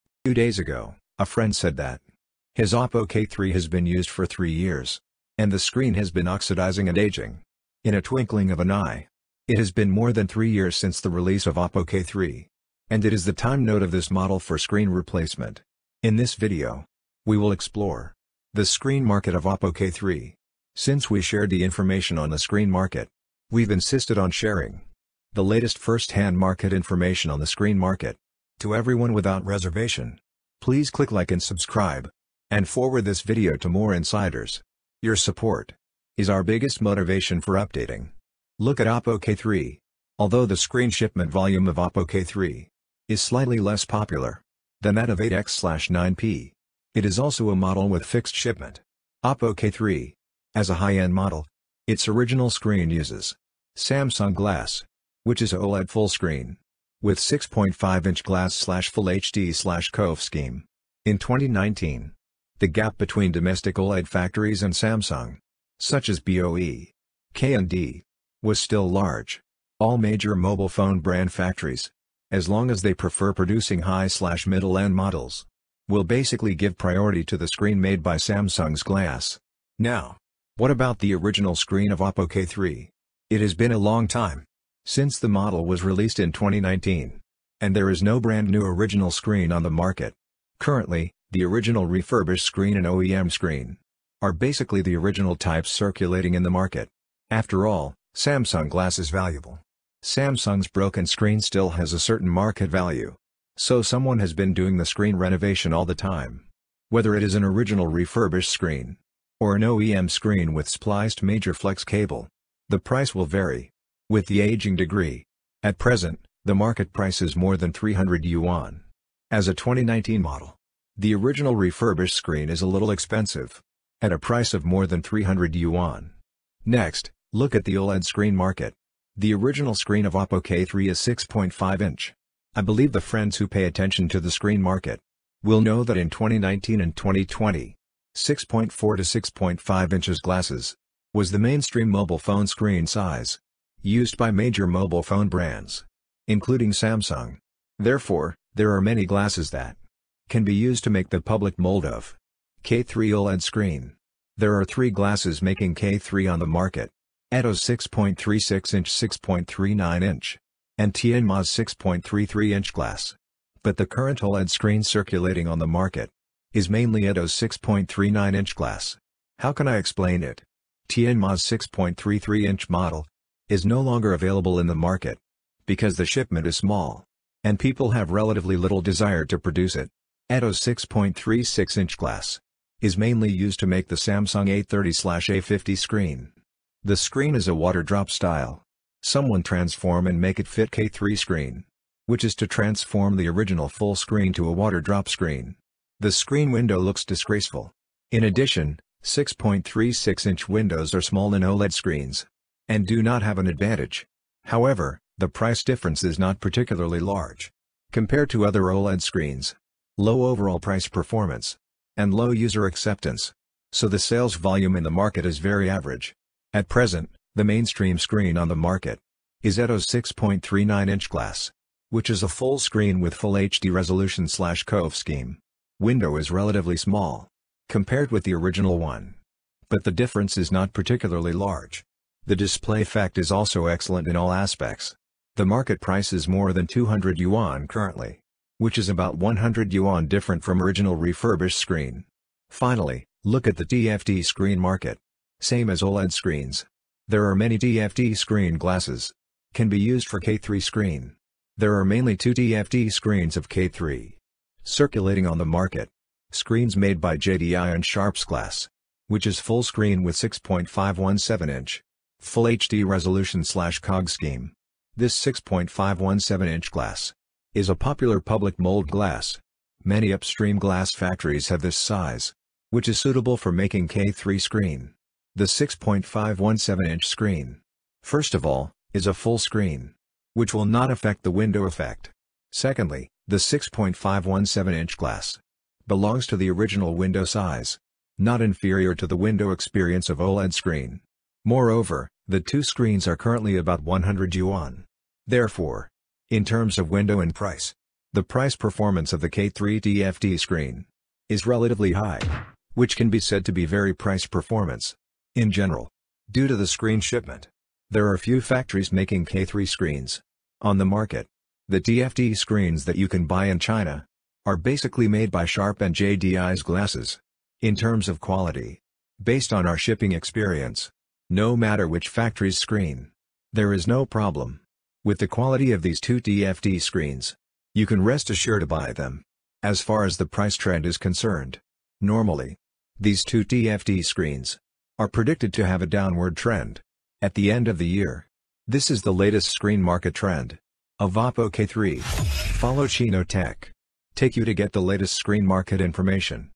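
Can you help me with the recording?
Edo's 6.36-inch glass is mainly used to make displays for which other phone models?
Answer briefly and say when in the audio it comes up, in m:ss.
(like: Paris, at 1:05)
Samsung A30-A50, at 3:03.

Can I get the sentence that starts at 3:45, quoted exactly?
Window is relatively small compared with the original one.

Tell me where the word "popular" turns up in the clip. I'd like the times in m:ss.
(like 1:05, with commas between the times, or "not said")
0:43, 4:27.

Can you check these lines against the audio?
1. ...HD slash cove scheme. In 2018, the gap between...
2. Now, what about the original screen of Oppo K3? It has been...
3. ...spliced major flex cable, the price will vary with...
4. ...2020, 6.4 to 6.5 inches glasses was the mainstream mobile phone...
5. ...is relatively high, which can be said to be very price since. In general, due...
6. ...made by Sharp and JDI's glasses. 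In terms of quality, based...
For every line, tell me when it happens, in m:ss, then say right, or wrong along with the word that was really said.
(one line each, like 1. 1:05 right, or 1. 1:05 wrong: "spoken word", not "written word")
1. 0:59 wrong: "2019", not "2018"
2. 1:19 right
3. 1:50 right
4. 2:16 right
5. 5:01 wrong: "performance", not "since"
6. 5:15 right.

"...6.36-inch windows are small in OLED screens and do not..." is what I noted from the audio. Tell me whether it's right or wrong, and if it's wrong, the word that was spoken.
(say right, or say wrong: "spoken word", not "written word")
right.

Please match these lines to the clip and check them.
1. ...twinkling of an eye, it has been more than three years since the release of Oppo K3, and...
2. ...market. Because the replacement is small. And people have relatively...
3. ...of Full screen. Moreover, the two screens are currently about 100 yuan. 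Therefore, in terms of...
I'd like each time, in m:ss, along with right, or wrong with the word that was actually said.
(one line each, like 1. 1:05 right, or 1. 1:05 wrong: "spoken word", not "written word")
1. 0:08 right
2. 2:54 wrong: "shipment", not "replacement"
3. 4:50 wrong: "OLED", not "Full".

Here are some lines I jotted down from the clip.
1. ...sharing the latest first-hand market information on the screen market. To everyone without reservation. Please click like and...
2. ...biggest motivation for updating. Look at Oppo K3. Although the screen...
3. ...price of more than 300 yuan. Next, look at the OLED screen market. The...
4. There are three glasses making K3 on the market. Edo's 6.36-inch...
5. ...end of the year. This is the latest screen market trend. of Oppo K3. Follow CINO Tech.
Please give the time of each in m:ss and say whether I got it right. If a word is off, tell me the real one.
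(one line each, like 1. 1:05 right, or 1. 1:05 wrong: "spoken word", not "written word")
1. 0:24 right
2. 0:36 right
3. 2:04 right
4. 2:34 right
5. 5:37 right.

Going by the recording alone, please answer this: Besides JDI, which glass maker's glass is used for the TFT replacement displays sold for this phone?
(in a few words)
Sharp.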